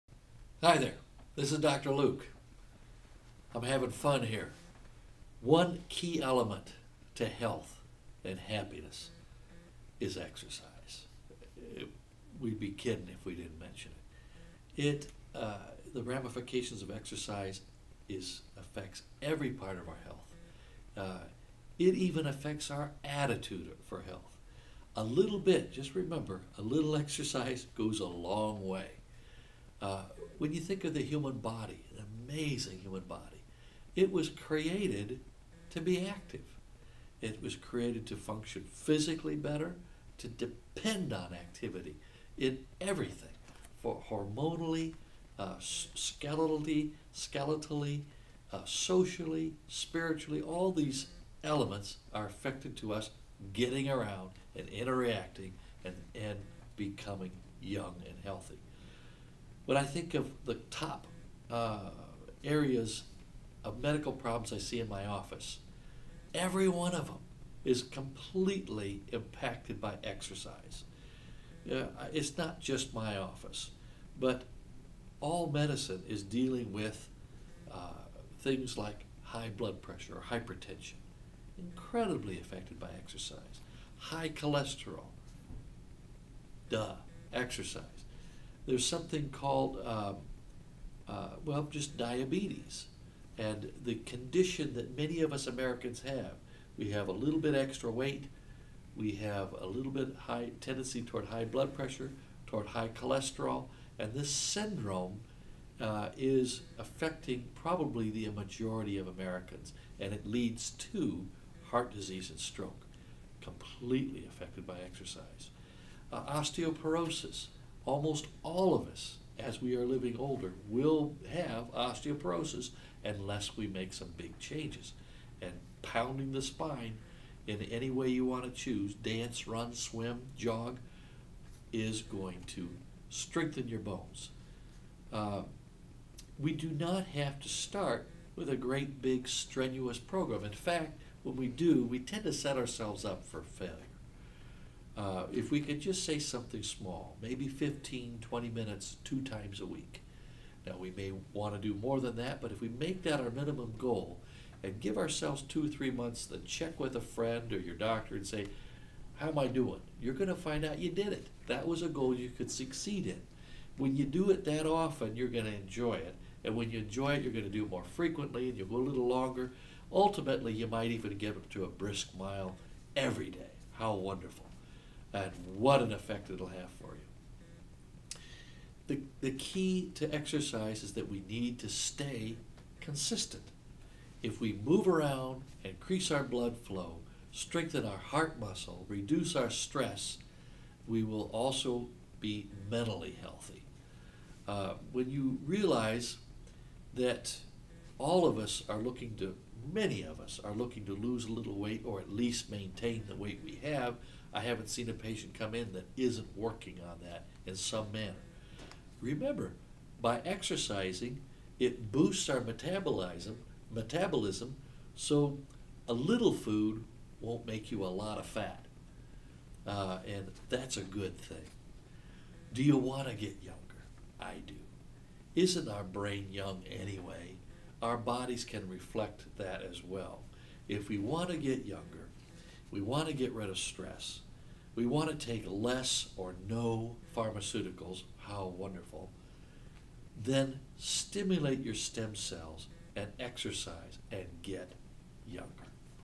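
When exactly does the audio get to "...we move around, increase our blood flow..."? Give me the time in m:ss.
3:04.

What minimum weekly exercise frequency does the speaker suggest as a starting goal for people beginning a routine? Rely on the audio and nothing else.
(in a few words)
two times a week.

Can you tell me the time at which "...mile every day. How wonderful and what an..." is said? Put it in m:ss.
2:52.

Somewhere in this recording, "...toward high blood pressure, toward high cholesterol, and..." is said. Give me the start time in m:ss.
1:41.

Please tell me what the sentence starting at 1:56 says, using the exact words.
Uh, osteoporosis, almost all of us, as we are living older, will have osteoporosis unless we make some big changes.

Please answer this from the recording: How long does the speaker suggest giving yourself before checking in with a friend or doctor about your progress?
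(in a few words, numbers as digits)
two, three months.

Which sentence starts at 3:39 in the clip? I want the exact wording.
Uh, and that's a good thing.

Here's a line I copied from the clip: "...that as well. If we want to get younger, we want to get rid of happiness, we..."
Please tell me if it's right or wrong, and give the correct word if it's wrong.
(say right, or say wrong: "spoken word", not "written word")
wrong: "stress", not "happiness".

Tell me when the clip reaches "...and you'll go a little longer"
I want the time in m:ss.
2:48.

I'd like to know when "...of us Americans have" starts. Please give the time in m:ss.
1:35.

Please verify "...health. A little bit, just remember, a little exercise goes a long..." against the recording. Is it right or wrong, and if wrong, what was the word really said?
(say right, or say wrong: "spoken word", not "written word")
right.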